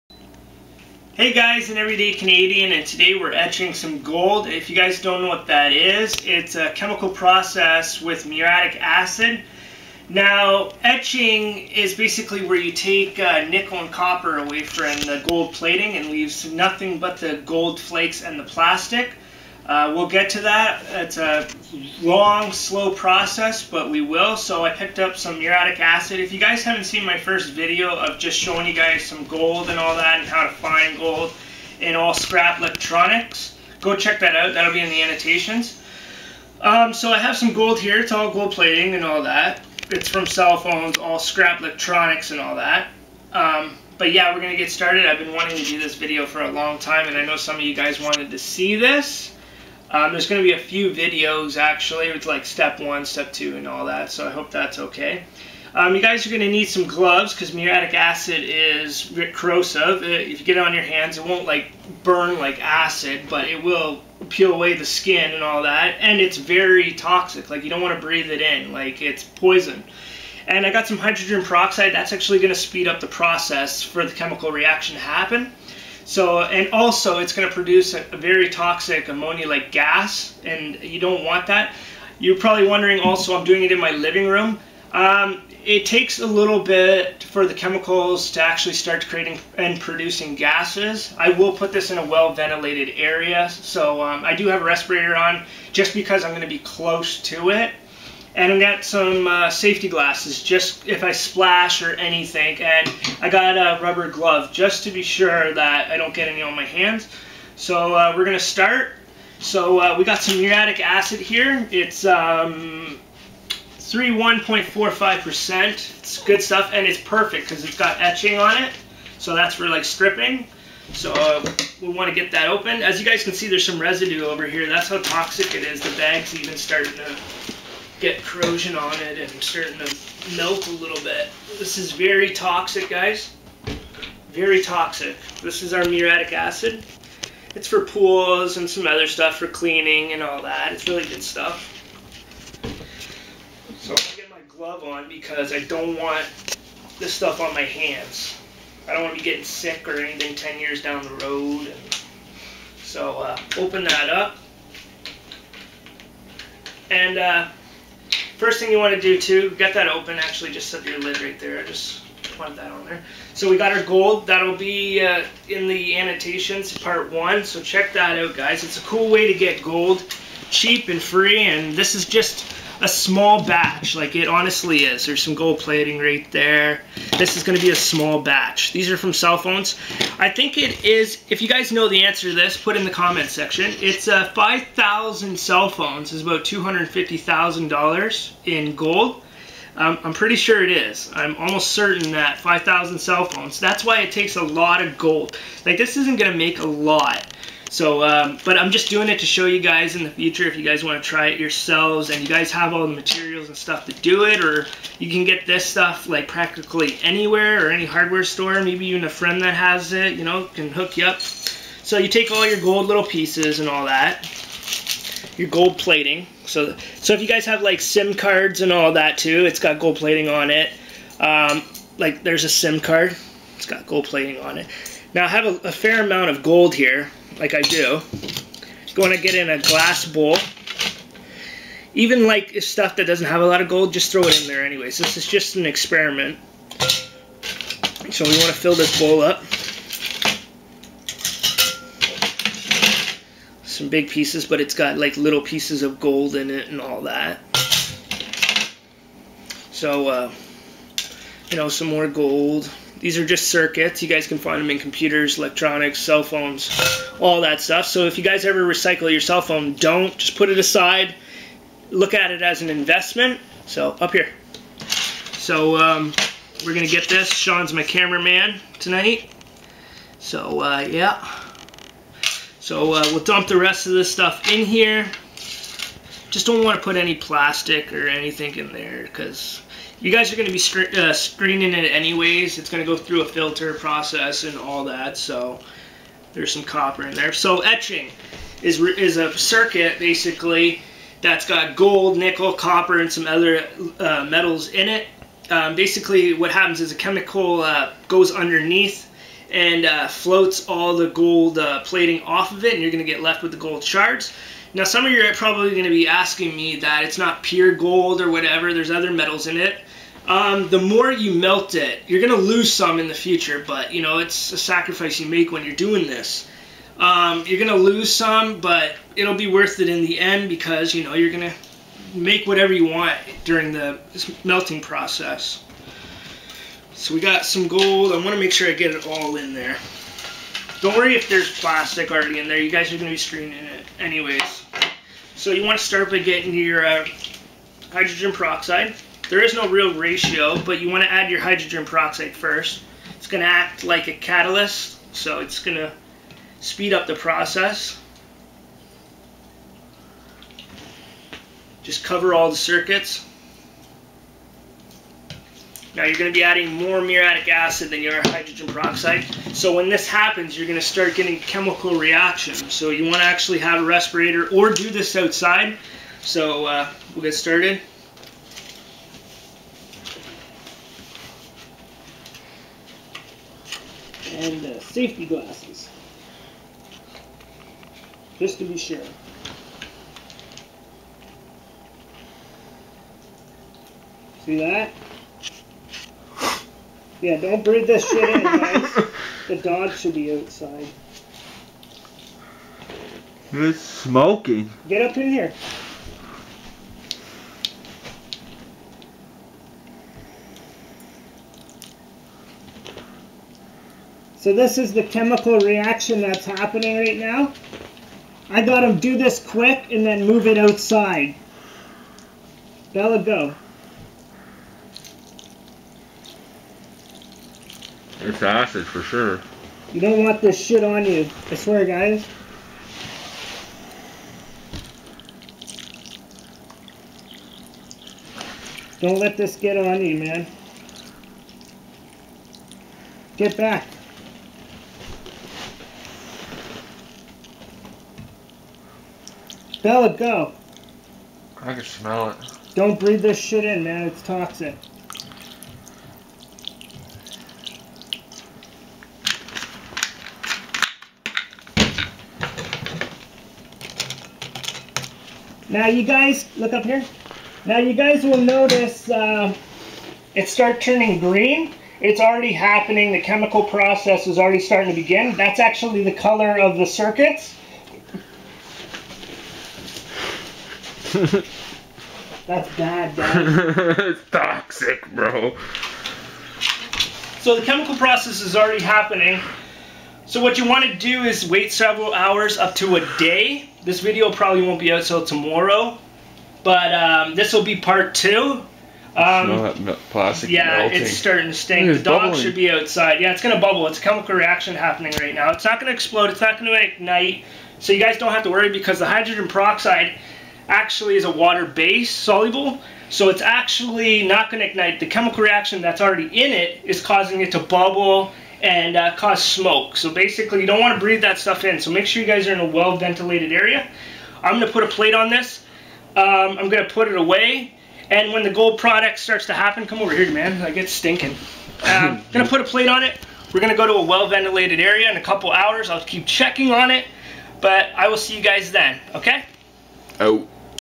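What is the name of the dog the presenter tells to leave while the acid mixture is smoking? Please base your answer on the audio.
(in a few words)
Bella.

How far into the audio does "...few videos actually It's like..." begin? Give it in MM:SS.
00:50.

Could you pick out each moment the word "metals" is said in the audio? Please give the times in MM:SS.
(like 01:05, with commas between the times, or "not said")
04:54, 05:09.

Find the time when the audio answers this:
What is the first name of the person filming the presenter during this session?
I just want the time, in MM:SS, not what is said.
04:27.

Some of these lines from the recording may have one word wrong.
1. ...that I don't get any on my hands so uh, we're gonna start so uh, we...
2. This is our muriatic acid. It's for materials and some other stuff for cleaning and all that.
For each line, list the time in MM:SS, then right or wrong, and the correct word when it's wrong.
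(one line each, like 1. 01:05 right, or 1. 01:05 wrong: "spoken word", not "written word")
1. 01:45 right
2. 02:15 wrong: "pools", not "materials".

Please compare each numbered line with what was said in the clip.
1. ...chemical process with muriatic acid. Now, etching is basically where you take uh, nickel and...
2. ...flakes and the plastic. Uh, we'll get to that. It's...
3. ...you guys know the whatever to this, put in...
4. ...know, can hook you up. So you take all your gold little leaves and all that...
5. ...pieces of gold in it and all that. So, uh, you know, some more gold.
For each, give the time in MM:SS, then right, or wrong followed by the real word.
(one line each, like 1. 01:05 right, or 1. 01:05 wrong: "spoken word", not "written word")
1. 00:06 right
2. 00:17 right
3. 03:01 wrong: "answer", not "whatever"
4. 03:30 wrong: "pieces", not "leaves"
5. 04:05 right.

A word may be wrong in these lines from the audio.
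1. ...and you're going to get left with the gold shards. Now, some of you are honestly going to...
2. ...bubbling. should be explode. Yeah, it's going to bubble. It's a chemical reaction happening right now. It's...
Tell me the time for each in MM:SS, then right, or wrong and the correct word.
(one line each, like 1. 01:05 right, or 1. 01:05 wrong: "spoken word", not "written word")
1. 05:02 wrong: "probably", not "honestly"
2. 08:12 wrong: "outside", not "explode".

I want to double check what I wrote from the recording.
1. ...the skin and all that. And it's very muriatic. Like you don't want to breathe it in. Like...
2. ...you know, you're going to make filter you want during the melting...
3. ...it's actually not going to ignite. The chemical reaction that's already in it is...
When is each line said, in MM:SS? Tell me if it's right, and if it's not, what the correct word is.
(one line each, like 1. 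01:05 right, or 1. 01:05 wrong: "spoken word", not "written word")
1. 01:04 wrong: "toxic", not "muriatic"
2. 05:20 wrong: "whatever", not "filter"
3. 08:23 right.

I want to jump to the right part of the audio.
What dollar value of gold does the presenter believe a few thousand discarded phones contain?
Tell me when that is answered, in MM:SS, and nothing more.
03:06.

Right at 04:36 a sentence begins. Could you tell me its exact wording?
Just don't want to put any plastic or anything in there because you guys are going to be uh, screening it anyways.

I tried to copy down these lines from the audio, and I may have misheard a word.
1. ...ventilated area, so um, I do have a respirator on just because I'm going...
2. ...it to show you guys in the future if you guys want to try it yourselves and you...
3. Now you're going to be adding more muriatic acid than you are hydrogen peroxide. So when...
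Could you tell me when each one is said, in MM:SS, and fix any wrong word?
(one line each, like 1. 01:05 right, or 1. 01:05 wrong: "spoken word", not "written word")
1. 01:32 right
2. 03:19 right
3. 05:55 right.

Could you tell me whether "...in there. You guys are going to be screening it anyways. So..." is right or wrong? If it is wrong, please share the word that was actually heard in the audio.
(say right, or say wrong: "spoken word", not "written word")
right.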